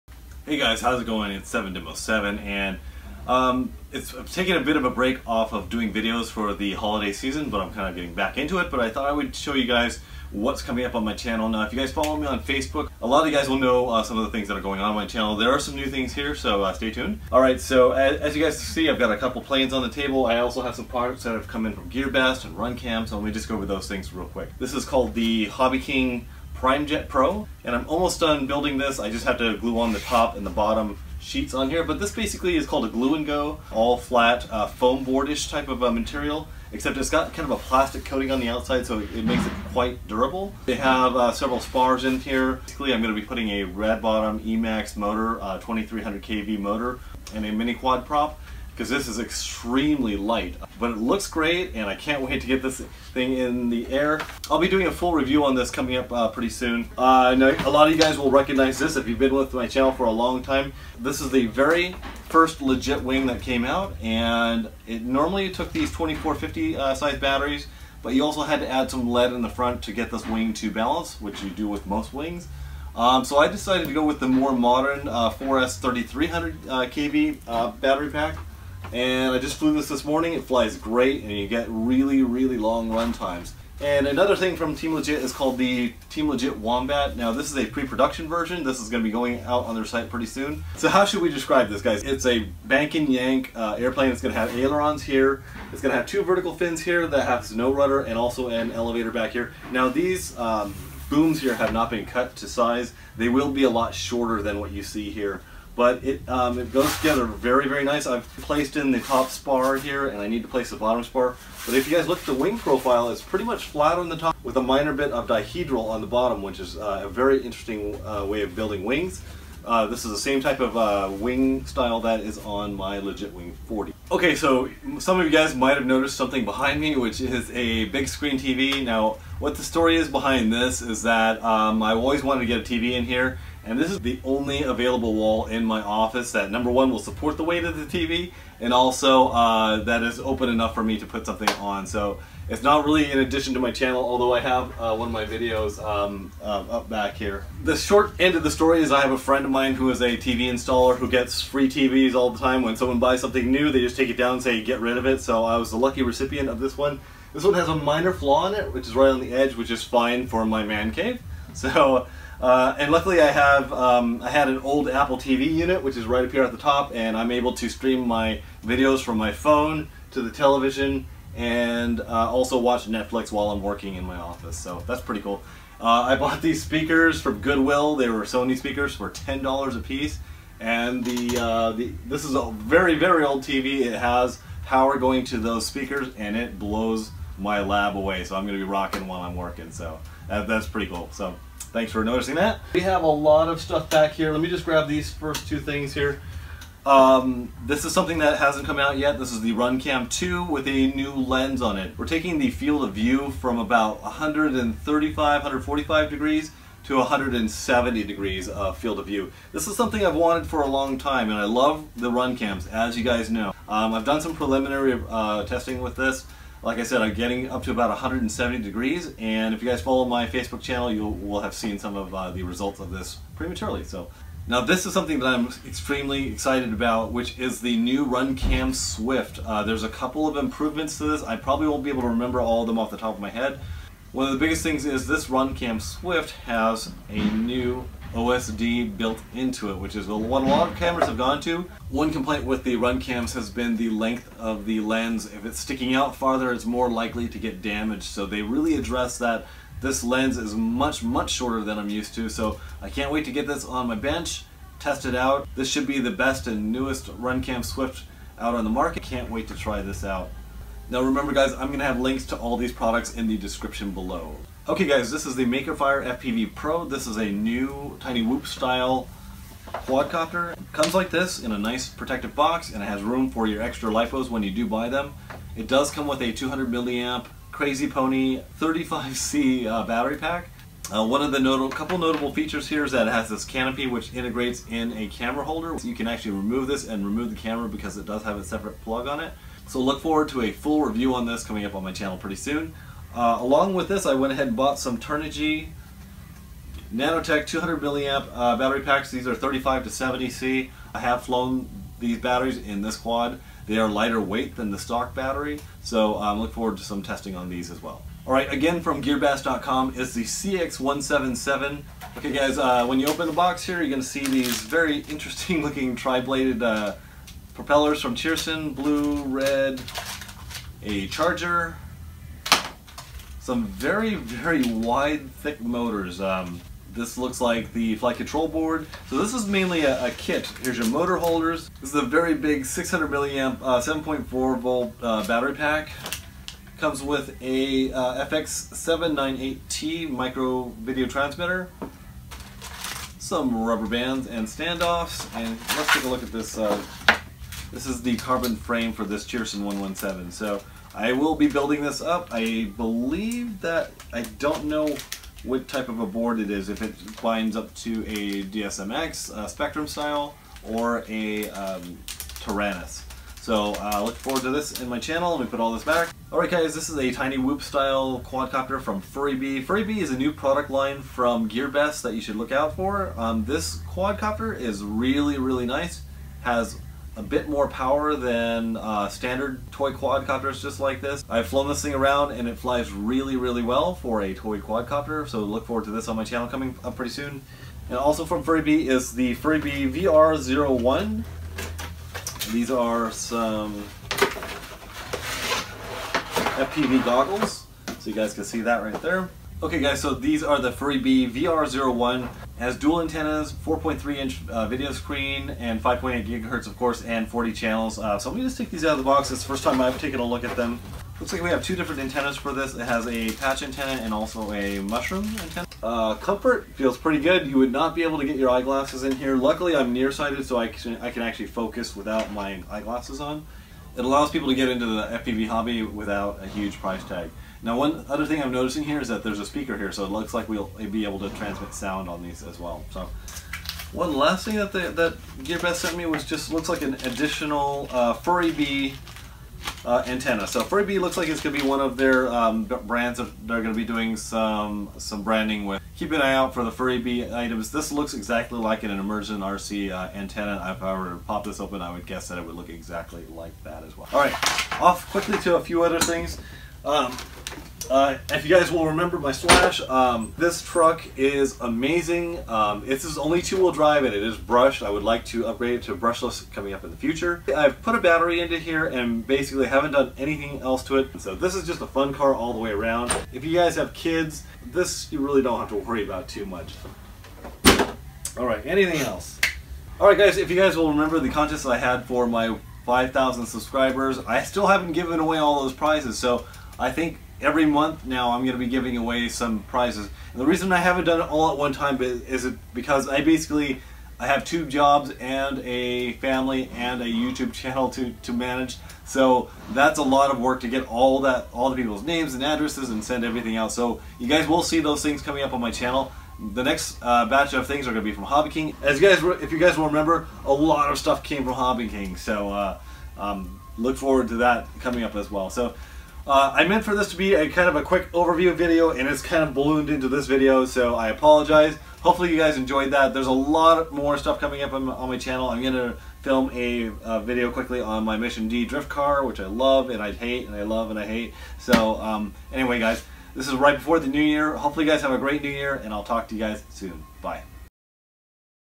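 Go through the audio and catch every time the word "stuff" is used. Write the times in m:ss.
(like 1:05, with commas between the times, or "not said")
3:13, 8:30, 8:44.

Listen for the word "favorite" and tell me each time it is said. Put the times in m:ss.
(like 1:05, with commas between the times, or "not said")
not said.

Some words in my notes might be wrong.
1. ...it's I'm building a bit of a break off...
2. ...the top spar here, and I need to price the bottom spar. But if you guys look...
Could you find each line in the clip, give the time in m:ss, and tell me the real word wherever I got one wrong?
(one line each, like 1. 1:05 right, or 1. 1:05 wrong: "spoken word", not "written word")
1. 0:03 wrong: "taking", not "building"
2. 1:48 wrong: "place", not "price".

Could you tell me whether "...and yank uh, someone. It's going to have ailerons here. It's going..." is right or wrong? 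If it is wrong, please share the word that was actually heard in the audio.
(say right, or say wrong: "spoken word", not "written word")
wrong: "airplane", not "someone".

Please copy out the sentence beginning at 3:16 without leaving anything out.
Um, this is something that hasn't come out yet.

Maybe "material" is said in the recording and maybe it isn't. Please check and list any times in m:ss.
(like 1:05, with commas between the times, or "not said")
0:35.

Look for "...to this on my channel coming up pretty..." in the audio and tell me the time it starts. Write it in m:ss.
6:25.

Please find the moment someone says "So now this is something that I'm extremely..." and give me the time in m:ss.
3:43.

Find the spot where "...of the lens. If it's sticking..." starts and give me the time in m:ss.
4:04.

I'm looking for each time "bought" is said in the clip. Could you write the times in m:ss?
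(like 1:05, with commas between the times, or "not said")
2:56, 4:54.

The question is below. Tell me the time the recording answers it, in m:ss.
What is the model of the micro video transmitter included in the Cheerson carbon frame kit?
5:38.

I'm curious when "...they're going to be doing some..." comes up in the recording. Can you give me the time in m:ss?
7:23.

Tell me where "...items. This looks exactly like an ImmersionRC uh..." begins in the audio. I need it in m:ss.
7:27.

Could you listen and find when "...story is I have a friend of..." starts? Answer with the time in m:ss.
2:28.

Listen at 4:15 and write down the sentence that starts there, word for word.
This should be the best and newest Runcam Swift out on the market.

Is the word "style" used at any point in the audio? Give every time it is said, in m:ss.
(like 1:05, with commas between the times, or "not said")
2:01, 4:28, 5:59, 6:07.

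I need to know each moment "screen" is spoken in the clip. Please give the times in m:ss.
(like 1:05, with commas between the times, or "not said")
2:08, 6:44.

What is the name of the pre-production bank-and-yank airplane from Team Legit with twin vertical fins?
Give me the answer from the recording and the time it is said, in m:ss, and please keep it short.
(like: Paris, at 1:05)
Team Legit Wombat, at 1:26.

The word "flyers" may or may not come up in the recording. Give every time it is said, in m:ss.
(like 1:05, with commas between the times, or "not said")
not said.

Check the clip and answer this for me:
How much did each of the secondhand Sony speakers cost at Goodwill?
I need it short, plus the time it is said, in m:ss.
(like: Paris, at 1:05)
$10, at 2:59.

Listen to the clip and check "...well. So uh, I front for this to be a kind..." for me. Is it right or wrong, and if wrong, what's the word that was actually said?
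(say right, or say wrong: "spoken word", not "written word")
wrong: "meant", not "front".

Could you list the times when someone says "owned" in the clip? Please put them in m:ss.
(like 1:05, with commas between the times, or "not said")
not said.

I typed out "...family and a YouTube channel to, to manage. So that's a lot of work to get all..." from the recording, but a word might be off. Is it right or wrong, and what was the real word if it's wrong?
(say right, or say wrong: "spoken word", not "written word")
right.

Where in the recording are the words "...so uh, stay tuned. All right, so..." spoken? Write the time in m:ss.
0:16.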